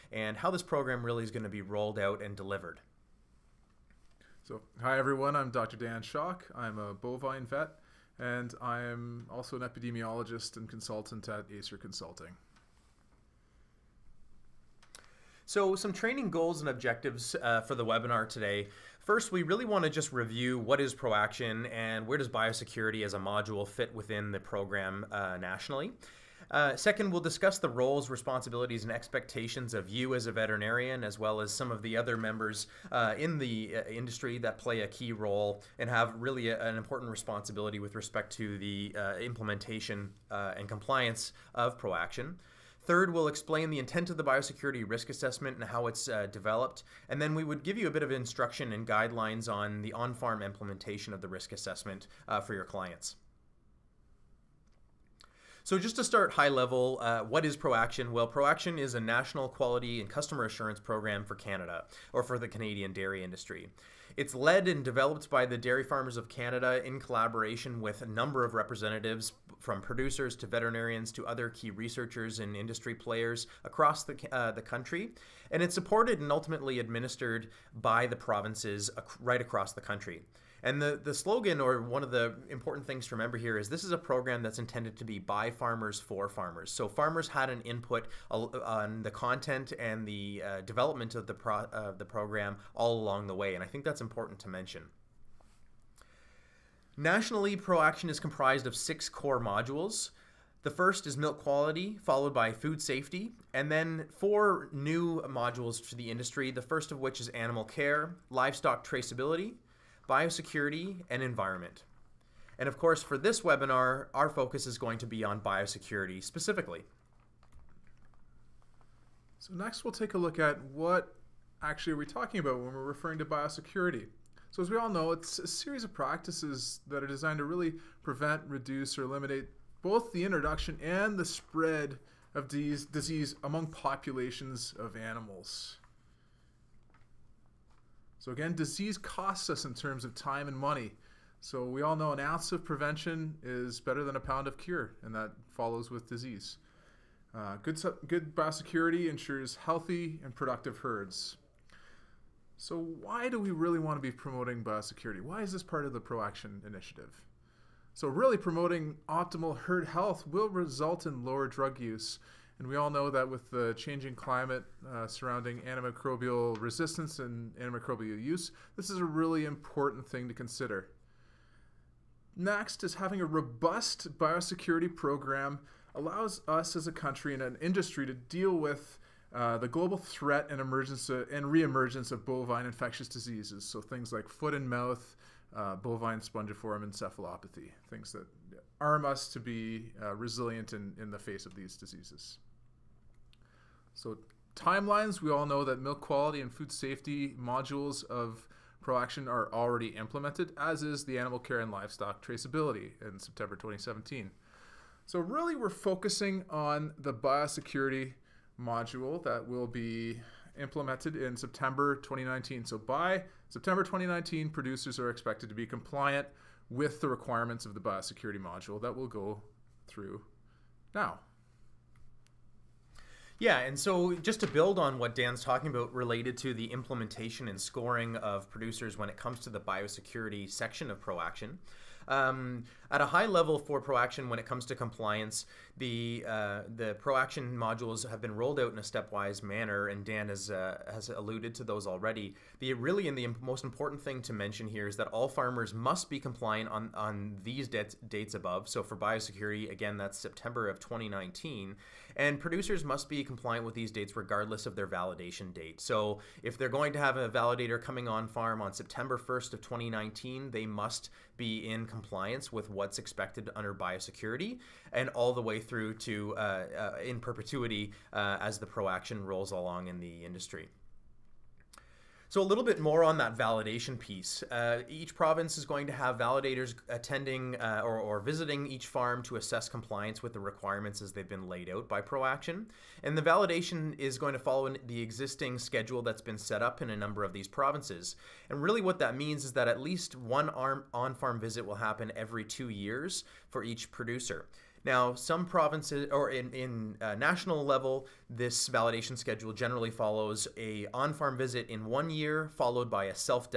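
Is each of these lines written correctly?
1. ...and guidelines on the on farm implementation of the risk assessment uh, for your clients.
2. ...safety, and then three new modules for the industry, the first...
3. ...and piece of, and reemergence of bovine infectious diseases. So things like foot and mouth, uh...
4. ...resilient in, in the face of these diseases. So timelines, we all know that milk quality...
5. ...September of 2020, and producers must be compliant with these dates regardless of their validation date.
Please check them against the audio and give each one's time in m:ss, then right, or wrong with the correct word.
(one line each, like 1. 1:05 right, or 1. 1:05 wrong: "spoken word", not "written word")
1. 0:48 right
2. 1:42 wrong: "four", not "three"
3. 3:00 wrong: "emergence", not "piece"
4. 3:10 right
5. 4:10 wrong: "2019", not "2020".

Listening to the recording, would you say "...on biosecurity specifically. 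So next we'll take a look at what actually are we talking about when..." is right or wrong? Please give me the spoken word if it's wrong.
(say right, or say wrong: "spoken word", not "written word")
right.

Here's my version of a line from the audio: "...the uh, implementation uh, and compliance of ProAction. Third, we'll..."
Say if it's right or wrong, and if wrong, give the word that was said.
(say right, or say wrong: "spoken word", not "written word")
right.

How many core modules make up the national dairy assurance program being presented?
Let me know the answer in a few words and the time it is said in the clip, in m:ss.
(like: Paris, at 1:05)
6, at 1:38.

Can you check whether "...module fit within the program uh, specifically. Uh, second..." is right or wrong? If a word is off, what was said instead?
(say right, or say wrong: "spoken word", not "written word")
wrong: "nationally", not "specifically".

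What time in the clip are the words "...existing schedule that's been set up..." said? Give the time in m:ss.
4:45.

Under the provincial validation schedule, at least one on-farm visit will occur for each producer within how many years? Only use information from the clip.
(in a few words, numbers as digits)
2 years.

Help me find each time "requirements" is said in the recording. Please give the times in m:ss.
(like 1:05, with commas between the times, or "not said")
3:37, 4:40.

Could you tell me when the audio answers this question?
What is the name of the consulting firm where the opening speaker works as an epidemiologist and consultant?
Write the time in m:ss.
0:11.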